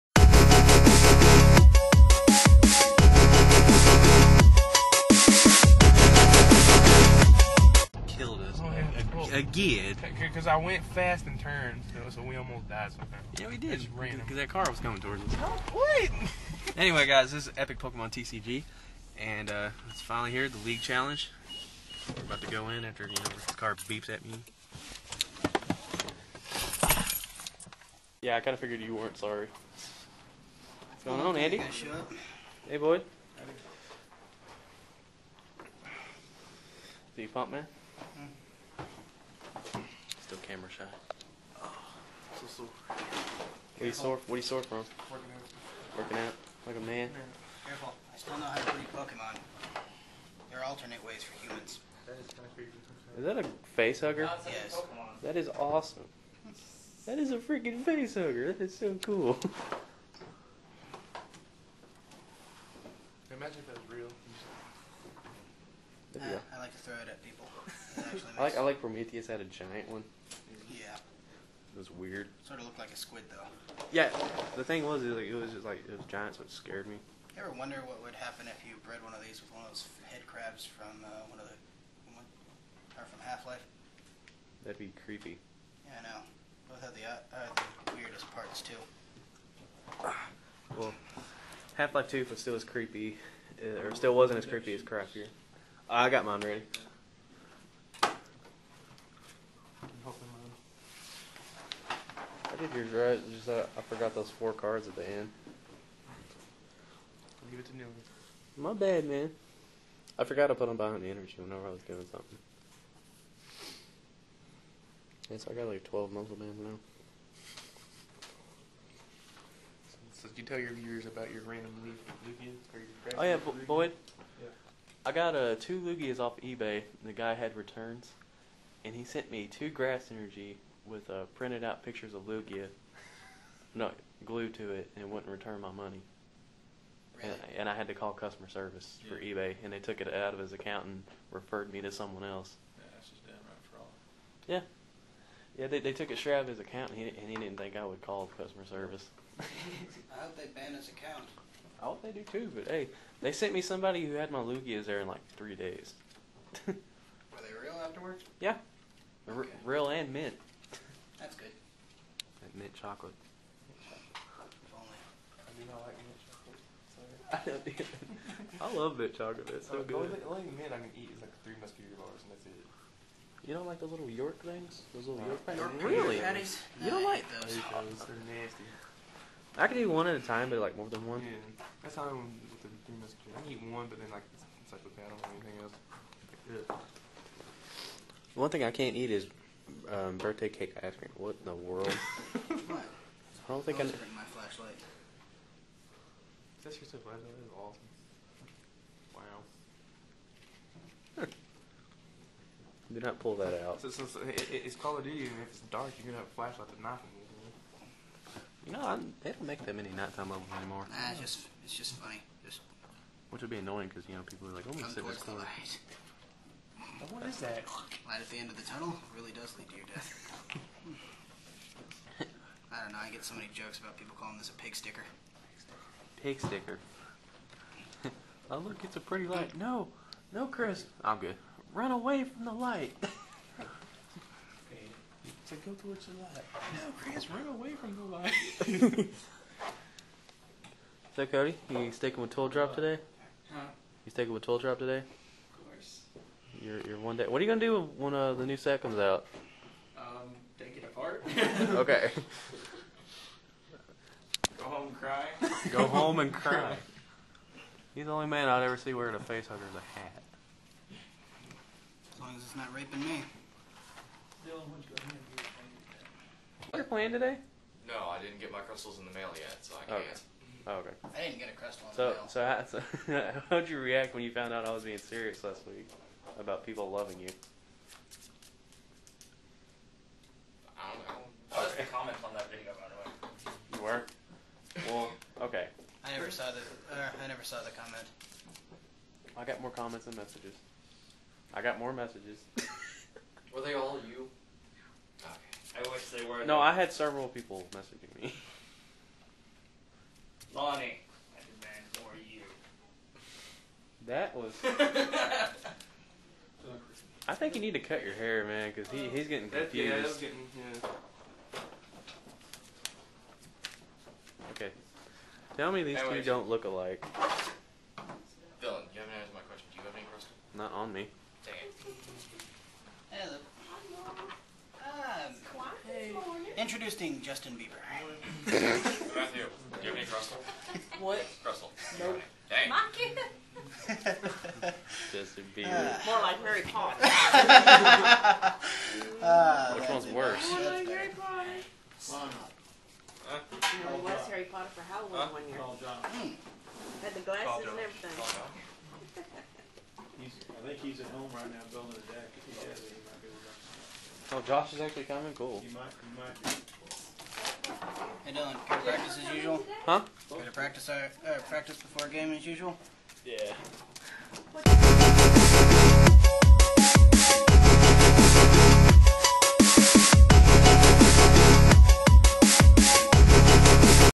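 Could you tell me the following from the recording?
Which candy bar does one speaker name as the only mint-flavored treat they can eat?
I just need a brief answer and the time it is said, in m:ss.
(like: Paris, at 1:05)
Three Musketeer bars, at 2:51.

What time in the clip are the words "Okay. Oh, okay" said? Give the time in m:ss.
4:30.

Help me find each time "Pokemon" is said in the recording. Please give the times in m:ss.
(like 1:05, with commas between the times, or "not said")
0:17, 0:48.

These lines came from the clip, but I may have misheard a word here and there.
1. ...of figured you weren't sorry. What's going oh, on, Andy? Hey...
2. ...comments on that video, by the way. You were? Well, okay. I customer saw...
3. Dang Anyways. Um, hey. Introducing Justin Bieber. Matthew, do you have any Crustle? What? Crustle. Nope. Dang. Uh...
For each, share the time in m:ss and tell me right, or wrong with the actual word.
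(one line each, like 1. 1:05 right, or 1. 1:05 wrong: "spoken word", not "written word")
1. 0:28 right
2. 4:41 wrong: "never", not "customer"
3. 5:21 wrong: "Hello", not "Anyways".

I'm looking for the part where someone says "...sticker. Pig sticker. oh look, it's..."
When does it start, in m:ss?
3:44.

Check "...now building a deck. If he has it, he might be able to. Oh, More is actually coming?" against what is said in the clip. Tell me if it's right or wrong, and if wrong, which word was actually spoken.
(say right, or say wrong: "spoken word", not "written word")
wrong: "Josh", not "More".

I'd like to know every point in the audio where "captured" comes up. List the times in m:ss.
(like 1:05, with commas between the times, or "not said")
not said.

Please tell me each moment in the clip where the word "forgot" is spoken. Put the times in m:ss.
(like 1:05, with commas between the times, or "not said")
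1:43, 1:50.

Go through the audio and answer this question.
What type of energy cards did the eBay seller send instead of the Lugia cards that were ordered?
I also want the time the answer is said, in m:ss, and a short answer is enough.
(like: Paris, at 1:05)
grass energy, at 2:09.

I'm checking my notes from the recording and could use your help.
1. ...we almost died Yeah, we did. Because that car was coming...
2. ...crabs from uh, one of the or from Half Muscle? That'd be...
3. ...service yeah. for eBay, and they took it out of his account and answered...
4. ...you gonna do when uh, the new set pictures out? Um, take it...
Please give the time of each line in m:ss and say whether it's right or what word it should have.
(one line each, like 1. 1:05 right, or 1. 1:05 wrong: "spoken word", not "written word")
1. 0:12 right
2. 1:20 wrong: "Life", not "Muscle"
3. 2:18 wrong: "referred", not "answered"
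4. 4:07 wrong: "comes", not "pictures".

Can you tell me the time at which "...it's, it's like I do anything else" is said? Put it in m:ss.
3:04.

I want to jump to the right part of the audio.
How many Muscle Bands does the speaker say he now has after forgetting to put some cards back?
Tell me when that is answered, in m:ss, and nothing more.
1:55.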